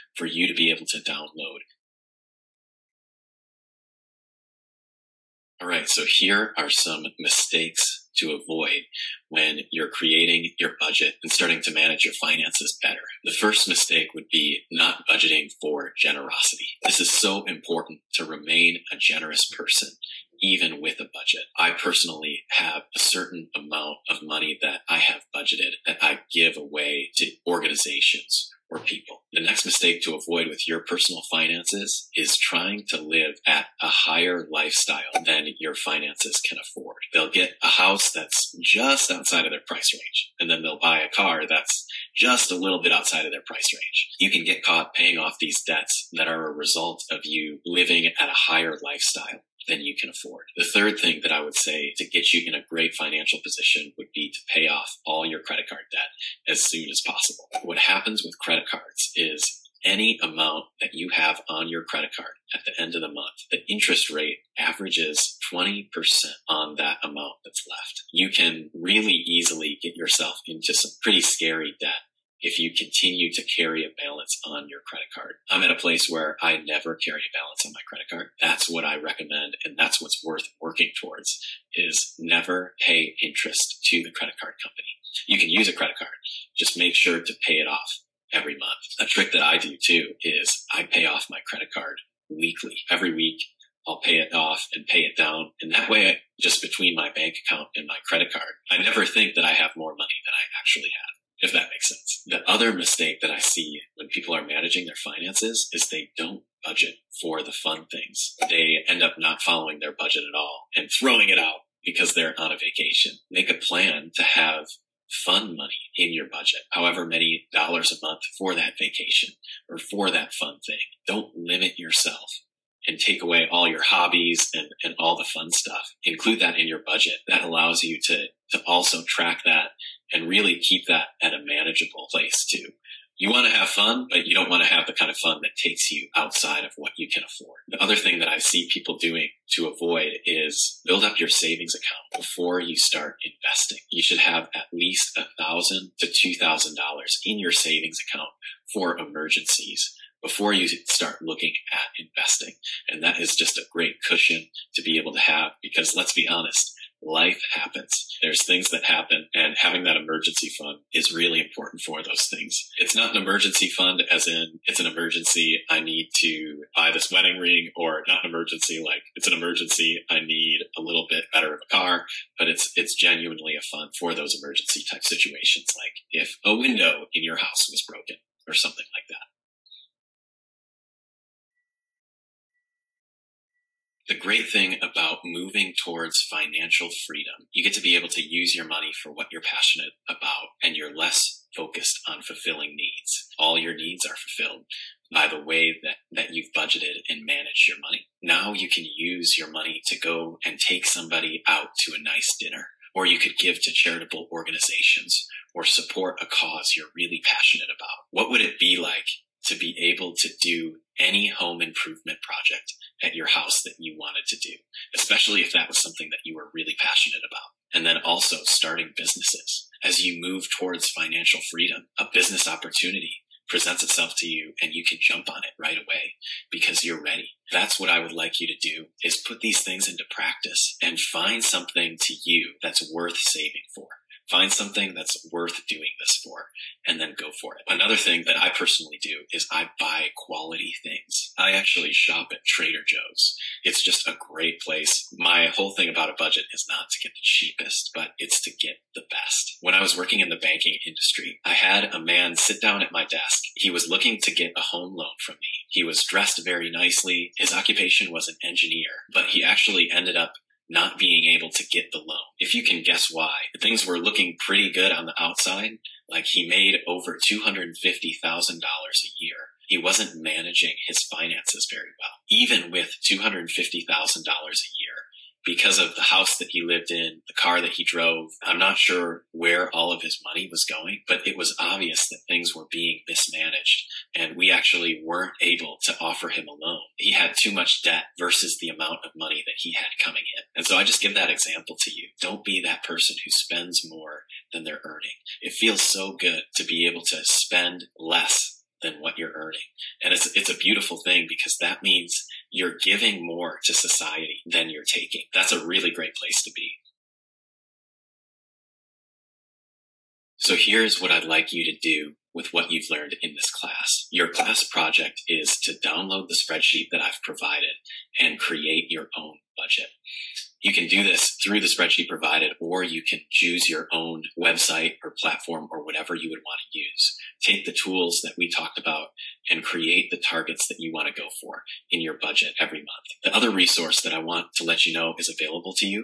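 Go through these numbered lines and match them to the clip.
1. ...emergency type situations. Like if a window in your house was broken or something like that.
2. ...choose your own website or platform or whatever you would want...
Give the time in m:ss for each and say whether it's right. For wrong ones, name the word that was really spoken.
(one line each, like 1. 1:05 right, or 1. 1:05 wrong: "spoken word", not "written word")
1. 2:54 right
2. 5:23 right.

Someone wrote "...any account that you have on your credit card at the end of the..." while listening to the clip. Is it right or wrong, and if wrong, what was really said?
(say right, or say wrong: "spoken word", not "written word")
wrong: "amount", not "account".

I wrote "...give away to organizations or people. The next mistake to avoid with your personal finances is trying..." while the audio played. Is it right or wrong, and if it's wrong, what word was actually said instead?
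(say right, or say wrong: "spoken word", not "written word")
right.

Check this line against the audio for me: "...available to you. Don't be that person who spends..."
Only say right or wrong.
wrong.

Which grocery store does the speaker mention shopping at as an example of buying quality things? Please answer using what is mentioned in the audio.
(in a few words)
Trader Joe's.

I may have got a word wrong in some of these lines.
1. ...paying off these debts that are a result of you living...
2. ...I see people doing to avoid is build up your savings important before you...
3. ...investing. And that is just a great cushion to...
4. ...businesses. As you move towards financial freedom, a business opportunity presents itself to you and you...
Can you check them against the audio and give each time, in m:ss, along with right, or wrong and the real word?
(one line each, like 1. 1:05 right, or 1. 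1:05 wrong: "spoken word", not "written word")
1. 0:44 right
2. 2:18 wrong: "account", not "important"
3. 2:31 right
4. 3:38 right.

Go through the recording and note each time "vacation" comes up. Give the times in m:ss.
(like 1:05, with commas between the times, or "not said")
1:52, 1:58.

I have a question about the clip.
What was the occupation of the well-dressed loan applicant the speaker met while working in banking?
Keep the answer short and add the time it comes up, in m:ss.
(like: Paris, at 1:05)
Engineer, at 4:18.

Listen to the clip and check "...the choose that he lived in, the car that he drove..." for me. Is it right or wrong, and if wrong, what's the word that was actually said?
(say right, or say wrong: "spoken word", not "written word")
wrong: "house", not "choose".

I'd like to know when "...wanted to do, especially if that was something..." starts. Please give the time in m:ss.
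3:33.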